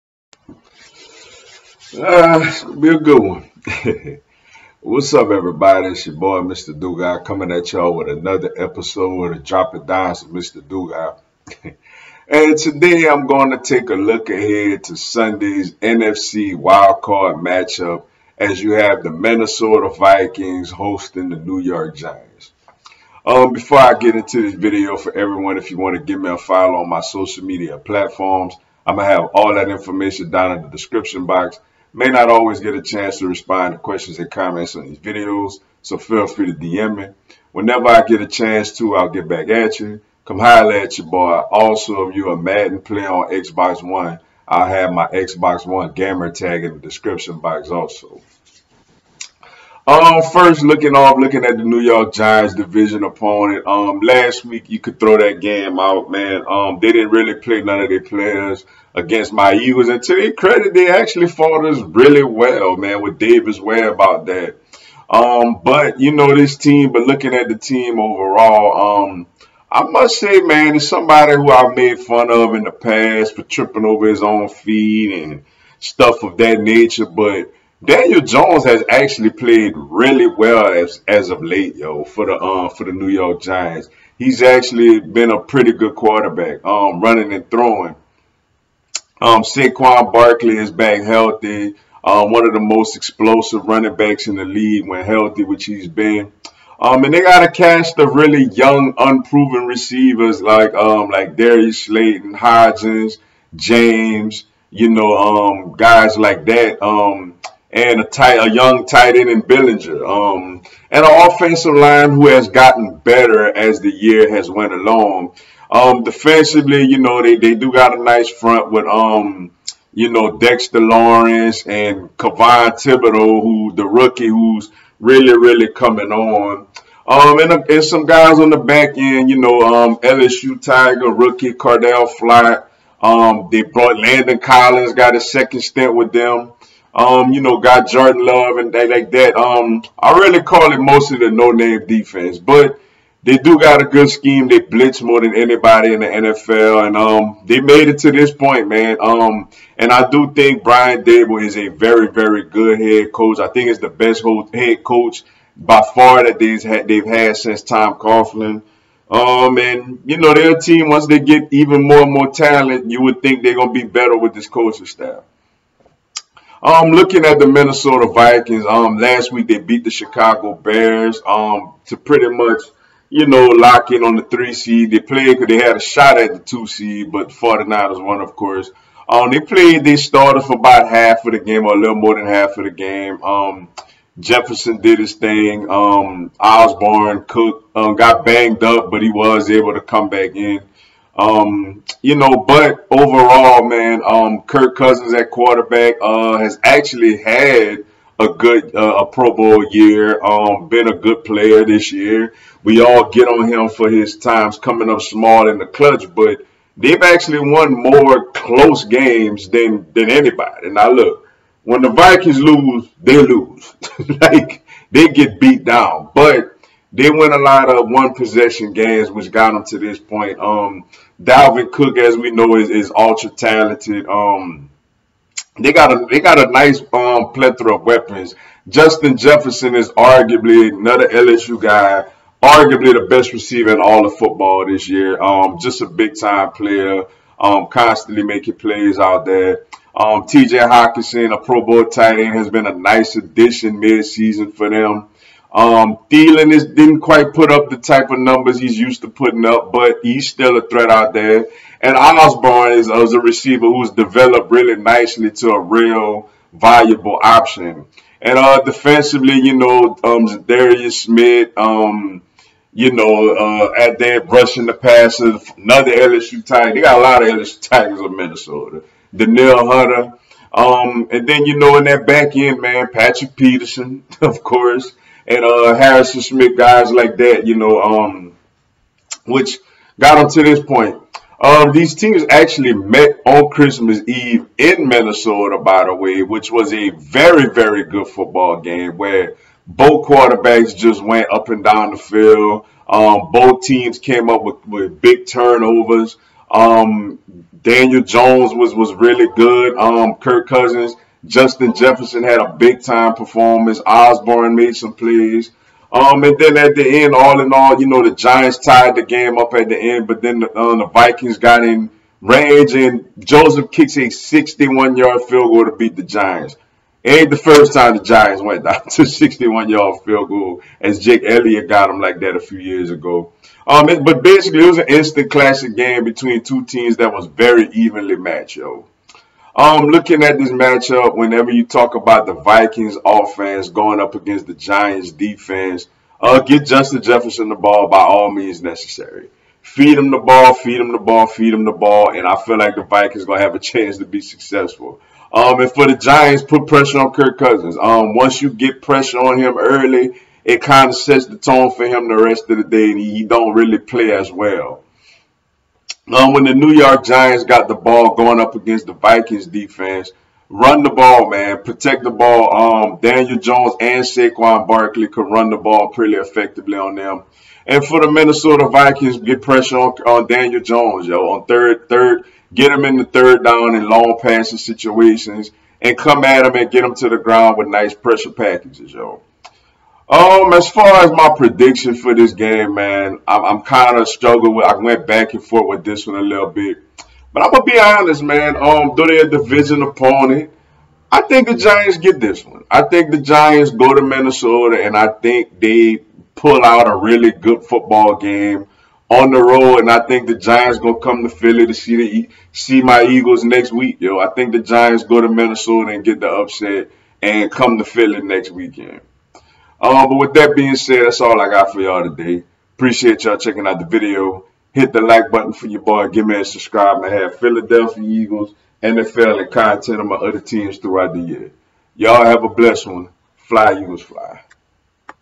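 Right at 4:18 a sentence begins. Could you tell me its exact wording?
And uh, defensively, you know, um, Darius Smith, um, you know, uh, at there brushing the passes, another LSU tight.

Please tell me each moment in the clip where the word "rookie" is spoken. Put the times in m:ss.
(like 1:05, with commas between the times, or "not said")
2:03, 2:11.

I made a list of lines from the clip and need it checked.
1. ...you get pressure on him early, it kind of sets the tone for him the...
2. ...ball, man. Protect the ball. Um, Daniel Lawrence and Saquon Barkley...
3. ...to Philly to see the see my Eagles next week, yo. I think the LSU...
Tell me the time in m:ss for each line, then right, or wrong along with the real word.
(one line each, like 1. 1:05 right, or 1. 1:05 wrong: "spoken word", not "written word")
1. 5:48 right
2. 6:00 wrong: "Jones", not "Lawrence"
3. 6:41 wrong: "Giants", not "LSU".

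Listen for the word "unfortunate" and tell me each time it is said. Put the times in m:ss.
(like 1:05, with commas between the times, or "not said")
not said.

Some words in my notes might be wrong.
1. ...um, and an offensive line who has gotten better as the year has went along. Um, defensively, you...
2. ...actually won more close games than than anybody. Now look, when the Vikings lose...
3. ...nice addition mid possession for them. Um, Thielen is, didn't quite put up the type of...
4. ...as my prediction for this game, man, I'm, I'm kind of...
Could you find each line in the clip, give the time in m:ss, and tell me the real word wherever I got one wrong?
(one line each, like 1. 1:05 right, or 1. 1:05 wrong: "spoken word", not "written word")
1. 1:50 right
2. 3:27 right
3. 4:02 wrong: "season", not "possession"
4. 6:21 right.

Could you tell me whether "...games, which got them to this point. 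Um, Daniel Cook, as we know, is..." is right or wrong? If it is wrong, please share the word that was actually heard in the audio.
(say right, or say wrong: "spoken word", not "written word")
wrong: "Dalvin", not "Daniel".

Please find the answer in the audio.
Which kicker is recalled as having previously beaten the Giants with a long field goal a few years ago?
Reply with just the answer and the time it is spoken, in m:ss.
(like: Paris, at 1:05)
Jake Elliott, at 5:20.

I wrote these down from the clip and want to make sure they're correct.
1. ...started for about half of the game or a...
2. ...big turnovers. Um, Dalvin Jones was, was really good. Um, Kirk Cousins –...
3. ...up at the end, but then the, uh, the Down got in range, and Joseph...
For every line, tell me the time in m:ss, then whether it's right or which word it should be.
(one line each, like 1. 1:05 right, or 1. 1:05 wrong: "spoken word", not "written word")
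1. 2:59 right
2. 4:55 wrong: "Daniel", not "Dalvin"
3. 5:09 wrong: "Vikings", not "Down".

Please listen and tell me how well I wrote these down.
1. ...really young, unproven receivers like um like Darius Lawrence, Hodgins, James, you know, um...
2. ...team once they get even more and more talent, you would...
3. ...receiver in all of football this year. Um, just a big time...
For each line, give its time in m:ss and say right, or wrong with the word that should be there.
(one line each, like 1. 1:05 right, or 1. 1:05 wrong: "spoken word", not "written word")
1. 1:38 wrong: "Slayton", not "Lawrence"
2. 2:40 right
3. 3:53 right.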